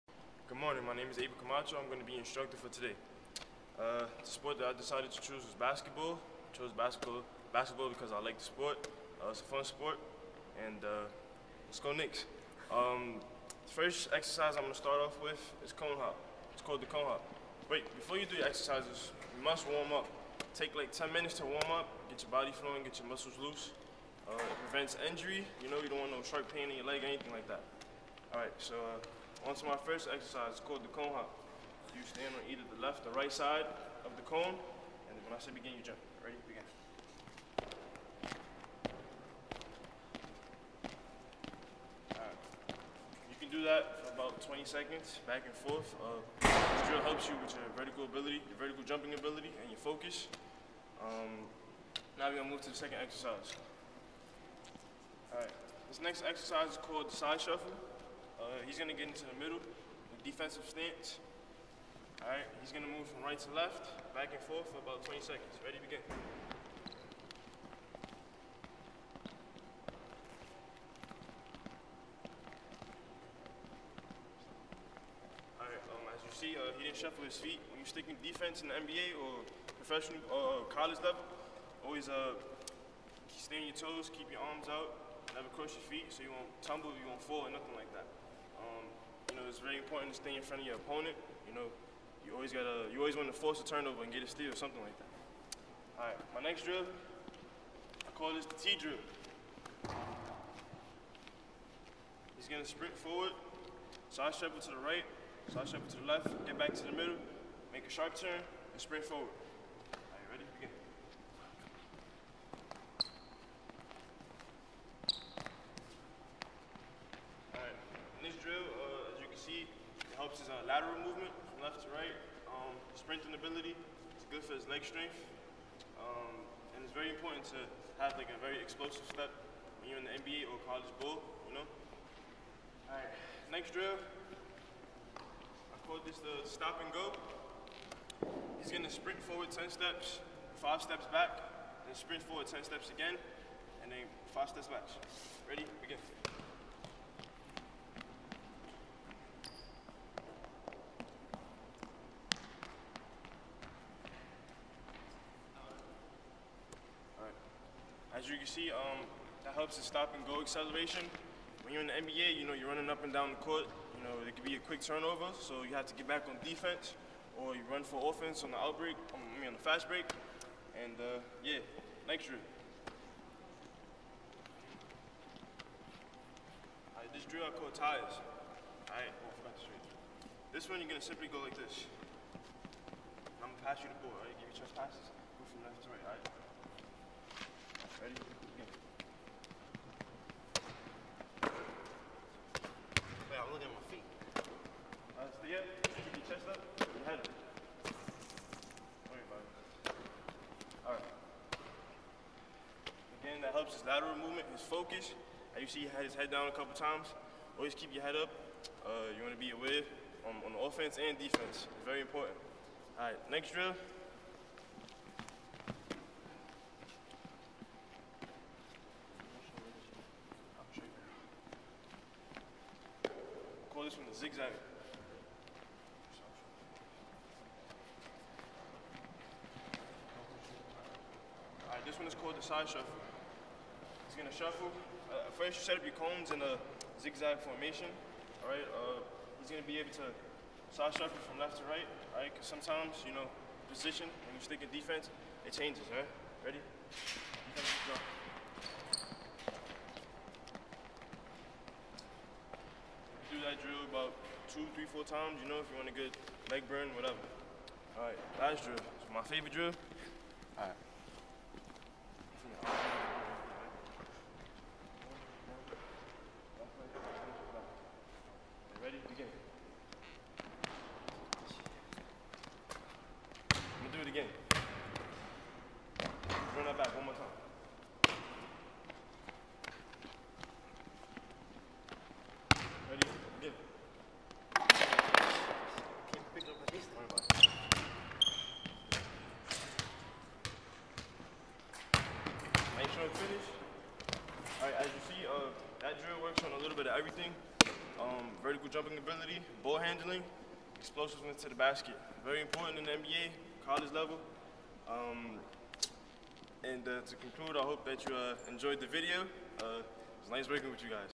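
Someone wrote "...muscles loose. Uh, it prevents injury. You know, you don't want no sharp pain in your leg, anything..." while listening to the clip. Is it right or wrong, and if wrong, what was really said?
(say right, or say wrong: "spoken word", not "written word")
right.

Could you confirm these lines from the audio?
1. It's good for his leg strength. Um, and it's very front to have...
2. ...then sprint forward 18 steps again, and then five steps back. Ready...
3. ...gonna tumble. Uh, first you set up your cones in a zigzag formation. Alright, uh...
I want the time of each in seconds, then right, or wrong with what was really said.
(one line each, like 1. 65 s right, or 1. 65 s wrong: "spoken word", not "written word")
1. 124 s wrong: "important", not "front"
2. 141 s wrong: "10", not "18"
3. 234 s wrong: "shuffle", not "tumble".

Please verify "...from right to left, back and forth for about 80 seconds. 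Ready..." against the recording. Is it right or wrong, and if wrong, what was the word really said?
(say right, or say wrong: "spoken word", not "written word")
wrong: "20", not "80".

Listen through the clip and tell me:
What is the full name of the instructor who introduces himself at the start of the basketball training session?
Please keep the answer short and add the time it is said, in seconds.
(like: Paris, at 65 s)
Abel Camacho, at 1 s.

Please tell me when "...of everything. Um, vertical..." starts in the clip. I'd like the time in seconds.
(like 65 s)
296 s.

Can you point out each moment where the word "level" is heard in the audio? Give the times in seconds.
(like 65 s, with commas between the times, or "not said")
81 s, 303 s.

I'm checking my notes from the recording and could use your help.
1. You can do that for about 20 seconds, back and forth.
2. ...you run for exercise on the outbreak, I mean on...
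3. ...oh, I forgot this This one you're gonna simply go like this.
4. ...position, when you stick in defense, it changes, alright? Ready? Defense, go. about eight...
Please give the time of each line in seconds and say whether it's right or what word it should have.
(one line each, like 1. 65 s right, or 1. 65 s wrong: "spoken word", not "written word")
1. 43 s right
2. 167 s wrong: "offense", not "exercise"
3. 179 s right
4. 243 s wrong: "two", not "eight".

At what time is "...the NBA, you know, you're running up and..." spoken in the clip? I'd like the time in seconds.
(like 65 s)
161 s.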